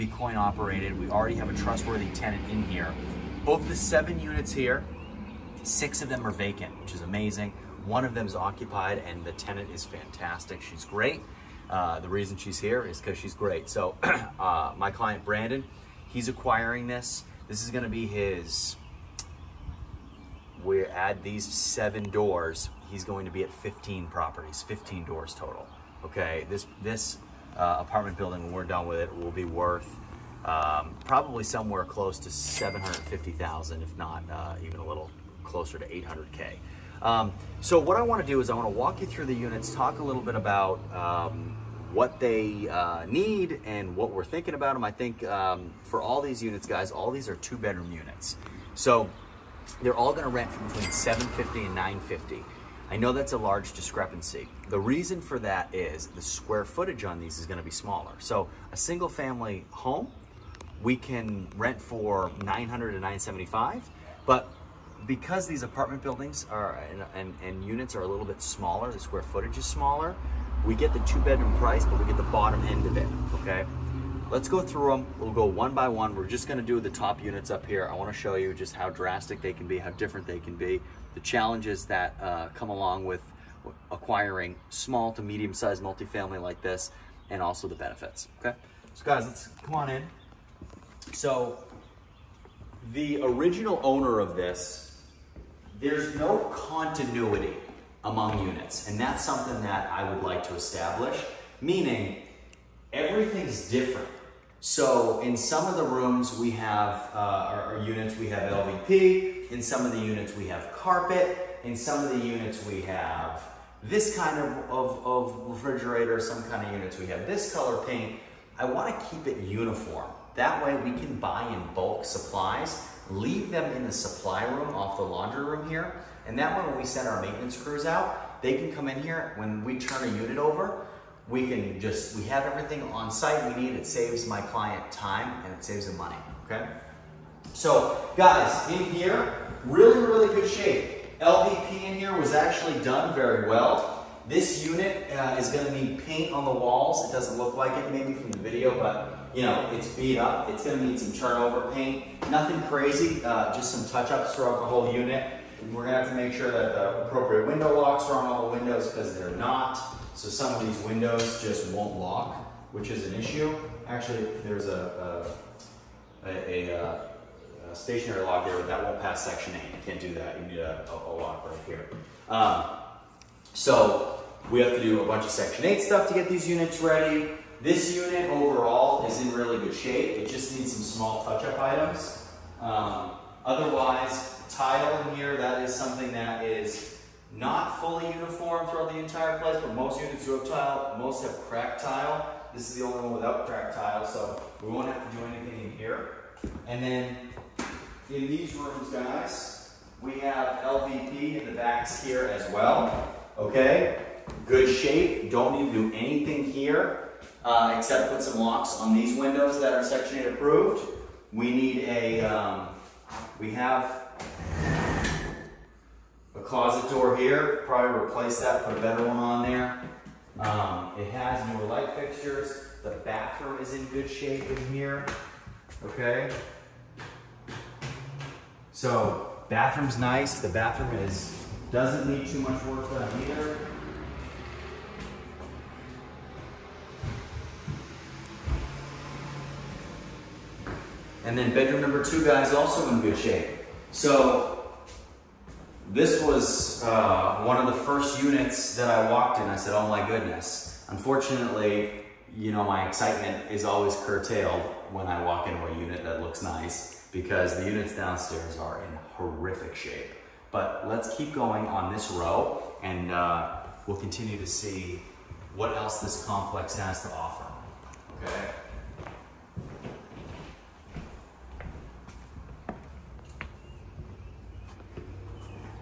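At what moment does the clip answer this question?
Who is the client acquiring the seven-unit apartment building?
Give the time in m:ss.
0:15.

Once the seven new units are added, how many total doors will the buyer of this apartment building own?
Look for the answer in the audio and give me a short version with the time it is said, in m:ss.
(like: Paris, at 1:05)
15, at 0:24.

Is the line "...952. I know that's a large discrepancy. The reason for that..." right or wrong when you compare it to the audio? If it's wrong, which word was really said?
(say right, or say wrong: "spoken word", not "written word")
wrong: "950", not "952".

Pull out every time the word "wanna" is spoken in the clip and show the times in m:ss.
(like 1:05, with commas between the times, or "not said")
1:17, 1:58.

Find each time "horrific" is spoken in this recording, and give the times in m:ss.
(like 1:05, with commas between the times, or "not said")
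4:19.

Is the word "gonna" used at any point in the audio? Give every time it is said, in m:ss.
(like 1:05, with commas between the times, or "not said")
0:17, 0:57, 1:16, 2:25, 2:30, 2:35.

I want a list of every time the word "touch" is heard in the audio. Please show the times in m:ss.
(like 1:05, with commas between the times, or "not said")
2:33, 3:01.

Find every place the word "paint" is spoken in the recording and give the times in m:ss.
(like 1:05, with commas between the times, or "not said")
1:57, 2:26, 2:31.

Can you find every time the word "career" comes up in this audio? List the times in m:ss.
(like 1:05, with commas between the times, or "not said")
not said.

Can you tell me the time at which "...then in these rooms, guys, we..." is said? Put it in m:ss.
3:16.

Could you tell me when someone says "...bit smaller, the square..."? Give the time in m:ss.
1:08.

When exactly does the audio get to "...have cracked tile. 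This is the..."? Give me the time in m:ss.
3:11.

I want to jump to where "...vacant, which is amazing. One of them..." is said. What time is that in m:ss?
0:06.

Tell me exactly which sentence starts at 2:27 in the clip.
It doesn't look like it maybe from the video, but you know, it's beat up.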